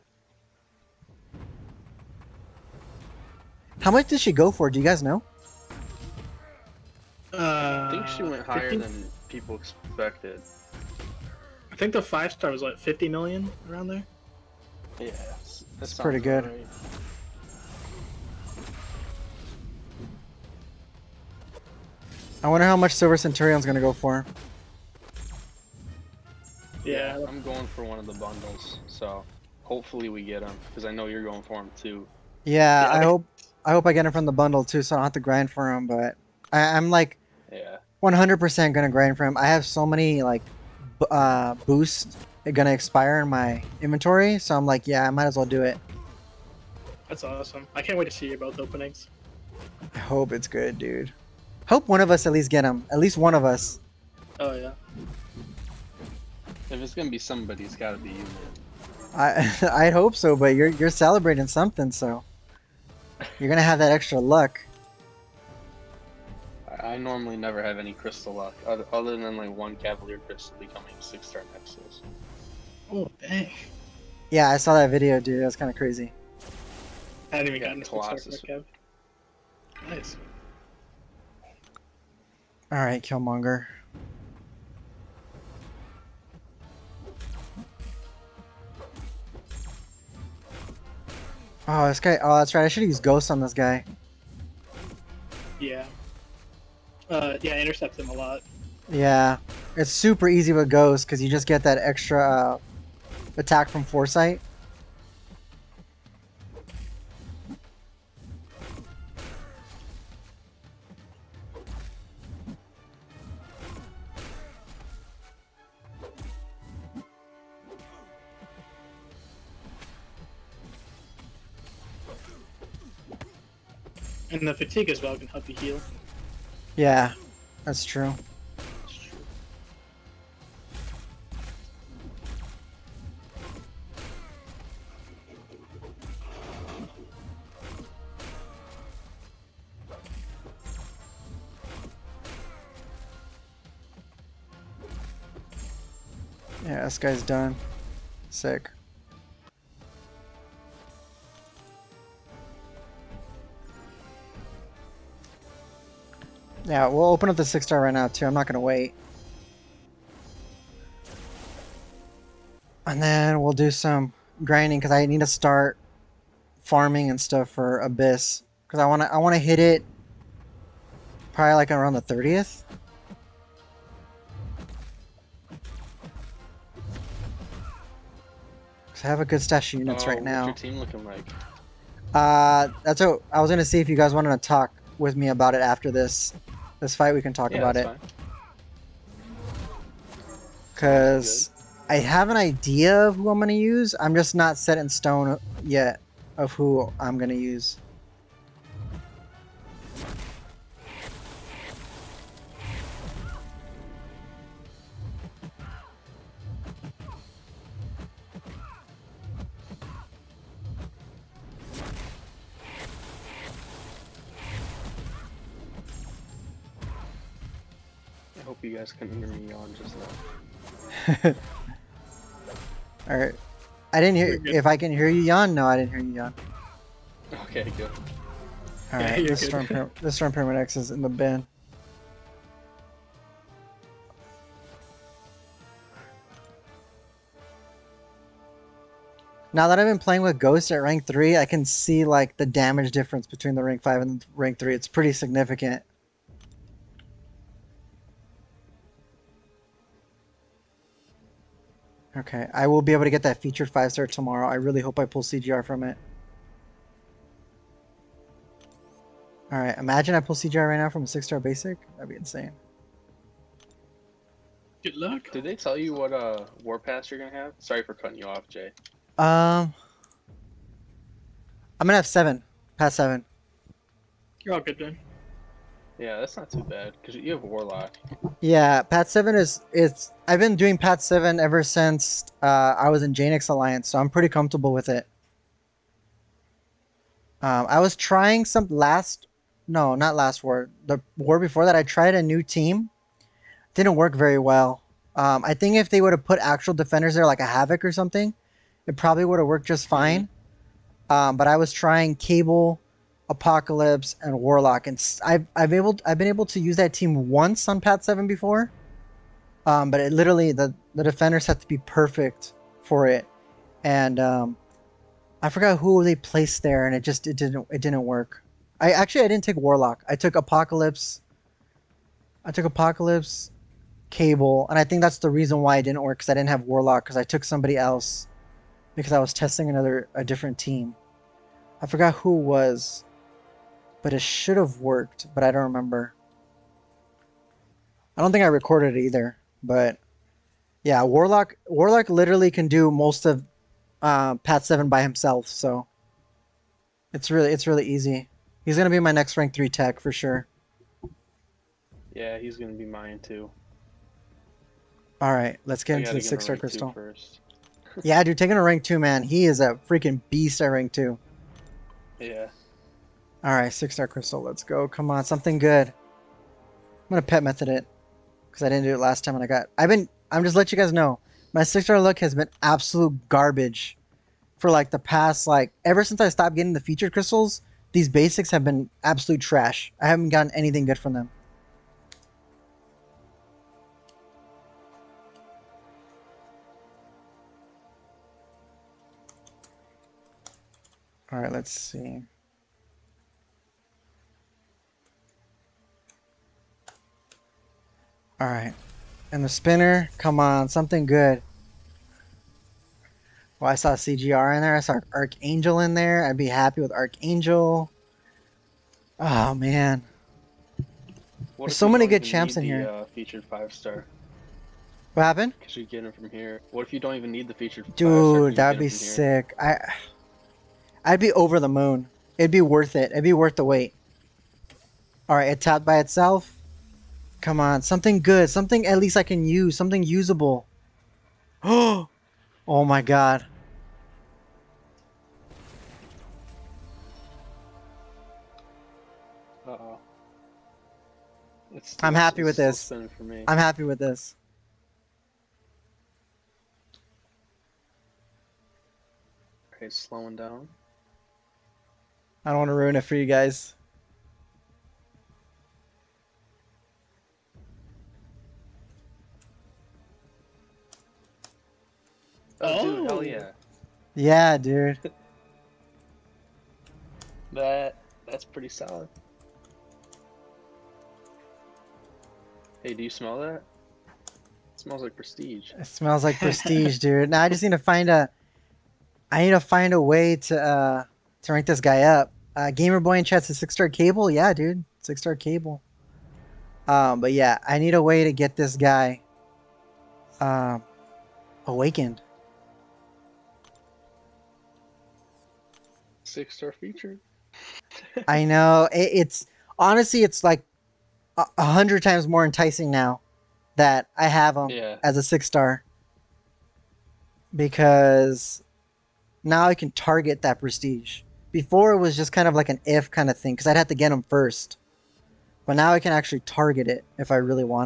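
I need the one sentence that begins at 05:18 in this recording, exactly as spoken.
I actually I didn't take Warlock.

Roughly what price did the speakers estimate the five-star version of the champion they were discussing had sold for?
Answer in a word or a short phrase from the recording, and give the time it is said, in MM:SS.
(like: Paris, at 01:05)
50 million, at 00:12.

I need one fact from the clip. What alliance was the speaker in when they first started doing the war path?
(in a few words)
Janix Alliance.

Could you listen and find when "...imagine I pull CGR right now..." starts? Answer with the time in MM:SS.
04:19.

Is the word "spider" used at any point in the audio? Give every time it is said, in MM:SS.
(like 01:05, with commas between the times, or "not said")
not said.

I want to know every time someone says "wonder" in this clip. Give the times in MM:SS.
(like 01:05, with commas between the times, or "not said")
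00:22.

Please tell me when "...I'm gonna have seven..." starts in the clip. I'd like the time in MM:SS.
04:31.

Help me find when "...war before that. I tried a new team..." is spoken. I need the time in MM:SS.
04:51.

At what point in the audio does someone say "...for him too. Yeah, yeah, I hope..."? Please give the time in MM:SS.
00:31.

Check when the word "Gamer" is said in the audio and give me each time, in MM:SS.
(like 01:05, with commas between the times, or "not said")
08:02.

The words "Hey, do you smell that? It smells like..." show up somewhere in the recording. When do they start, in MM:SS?
07:52.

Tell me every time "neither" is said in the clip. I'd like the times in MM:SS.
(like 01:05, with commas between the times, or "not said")
not said.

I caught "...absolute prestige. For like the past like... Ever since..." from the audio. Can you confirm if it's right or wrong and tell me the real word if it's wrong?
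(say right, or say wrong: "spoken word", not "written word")
wrong: "garbage", not "prestige".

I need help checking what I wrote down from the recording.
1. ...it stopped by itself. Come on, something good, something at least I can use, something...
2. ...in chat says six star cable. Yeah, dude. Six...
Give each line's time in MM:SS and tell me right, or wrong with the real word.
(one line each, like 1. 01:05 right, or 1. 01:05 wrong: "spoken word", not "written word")
1. 07:05 wrong: "tapped", not "stopped"
2. 08:03 right.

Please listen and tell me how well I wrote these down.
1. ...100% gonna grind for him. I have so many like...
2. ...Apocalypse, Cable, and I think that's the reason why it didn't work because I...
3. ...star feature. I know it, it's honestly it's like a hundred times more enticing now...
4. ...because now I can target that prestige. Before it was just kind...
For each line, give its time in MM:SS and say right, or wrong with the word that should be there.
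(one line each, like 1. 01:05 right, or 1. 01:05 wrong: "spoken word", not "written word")
1. 00:38 right
2. 05:22 right
3. 08:16 right
4. 08:27 right.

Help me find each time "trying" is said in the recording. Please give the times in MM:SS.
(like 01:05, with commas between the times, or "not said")
04:47, 05:01.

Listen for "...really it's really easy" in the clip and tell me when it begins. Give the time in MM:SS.
05:47.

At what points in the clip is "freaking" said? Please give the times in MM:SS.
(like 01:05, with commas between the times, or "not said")
05:59.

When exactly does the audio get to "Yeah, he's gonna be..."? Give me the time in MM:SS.
05:52.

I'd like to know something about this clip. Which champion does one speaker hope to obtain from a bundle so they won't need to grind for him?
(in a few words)
Silver Centurion.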